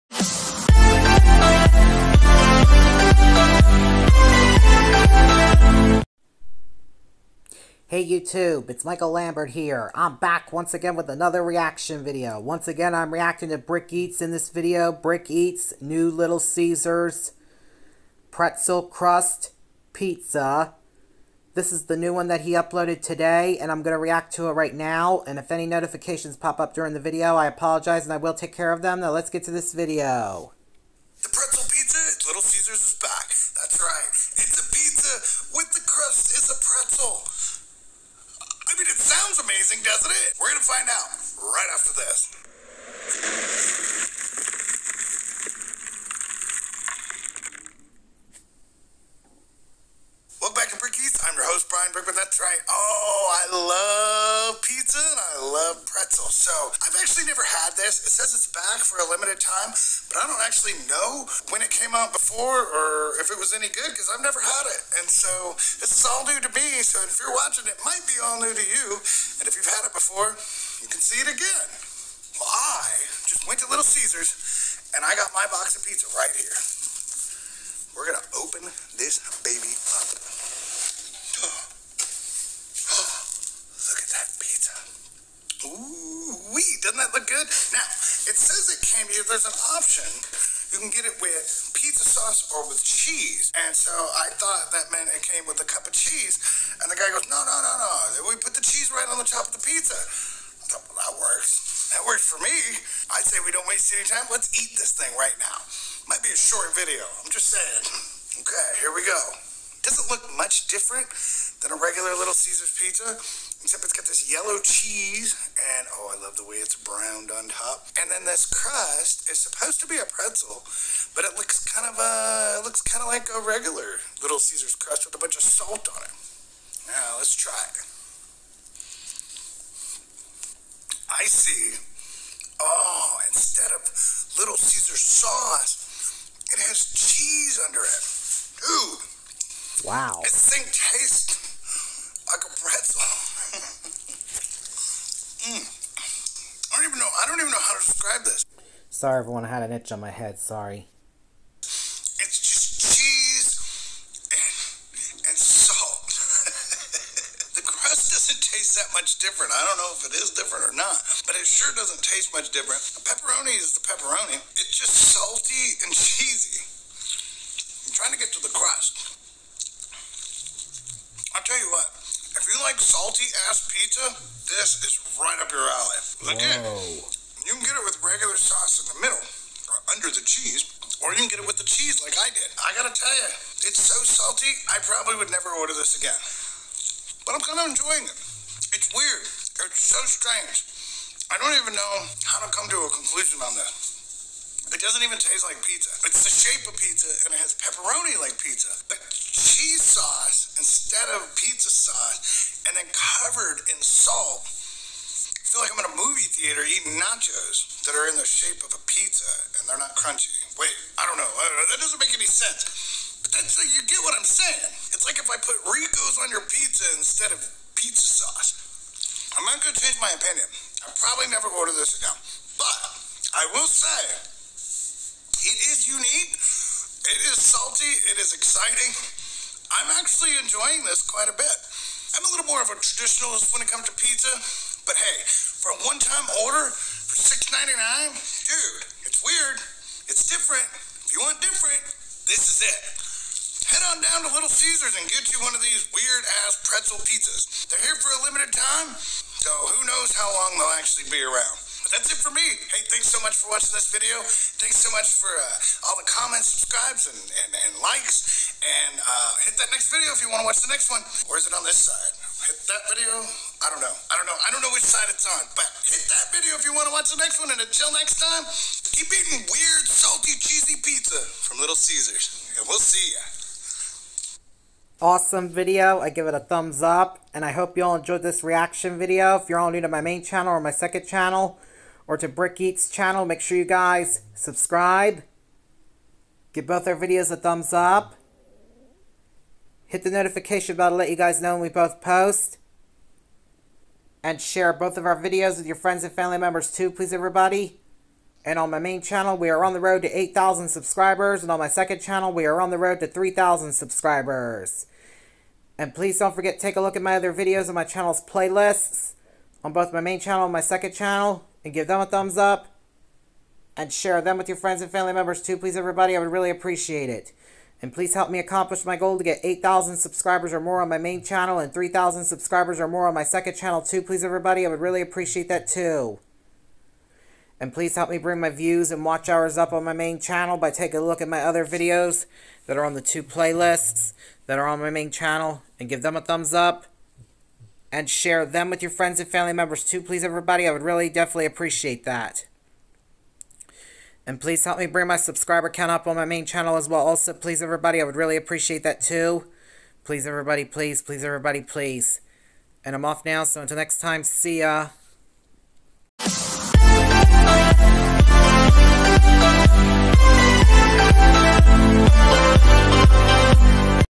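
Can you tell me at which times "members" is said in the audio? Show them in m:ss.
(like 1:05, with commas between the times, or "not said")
4:56, 5:15, 5:39.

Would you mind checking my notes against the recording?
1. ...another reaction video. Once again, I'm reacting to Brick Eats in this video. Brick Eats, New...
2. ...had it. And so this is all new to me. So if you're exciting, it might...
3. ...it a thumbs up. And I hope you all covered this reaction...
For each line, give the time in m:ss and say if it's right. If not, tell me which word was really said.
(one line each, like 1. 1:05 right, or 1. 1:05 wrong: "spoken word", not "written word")
1. 0:11 right
2. 1:04 wrong: "watching", not "exciting"
3. 4:36 wrong: "enjoyed", not "covered".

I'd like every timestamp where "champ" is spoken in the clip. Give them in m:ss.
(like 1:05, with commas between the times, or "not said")
not said.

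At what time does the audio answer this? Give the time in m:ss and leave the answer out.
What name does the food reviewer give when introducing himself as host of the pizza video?
0:51.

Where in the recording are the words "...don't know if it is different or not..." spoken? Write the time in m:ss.
2:39.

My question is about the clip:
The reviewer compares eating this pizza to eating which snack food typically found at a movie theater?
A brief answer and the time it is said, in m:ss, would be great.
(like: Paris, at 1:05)
nachos, at 3:26.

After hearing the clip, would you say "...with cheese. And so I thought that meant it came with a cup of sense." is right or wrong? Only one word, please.
wrong.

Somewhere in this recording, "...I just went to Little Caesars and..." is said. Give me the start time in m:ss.
1:12.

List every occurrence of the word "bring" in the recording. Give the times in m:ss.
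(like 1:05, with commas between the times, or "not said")
5:28, 5:44.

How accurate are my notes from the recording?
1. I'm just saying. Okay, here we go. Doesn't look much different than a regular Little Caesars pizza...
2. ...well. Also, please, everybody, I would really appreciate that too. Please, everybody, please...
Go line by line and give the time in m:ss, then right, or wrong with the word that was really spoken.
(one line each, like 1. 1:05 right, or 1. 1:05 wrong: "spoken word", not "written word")
1. 1:47 right
2. 5:46 right.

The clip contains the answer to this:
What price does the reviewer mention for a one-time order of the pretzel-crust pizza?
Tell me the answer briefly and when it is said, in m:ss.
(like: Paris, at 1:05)
$6.99, at 3:57.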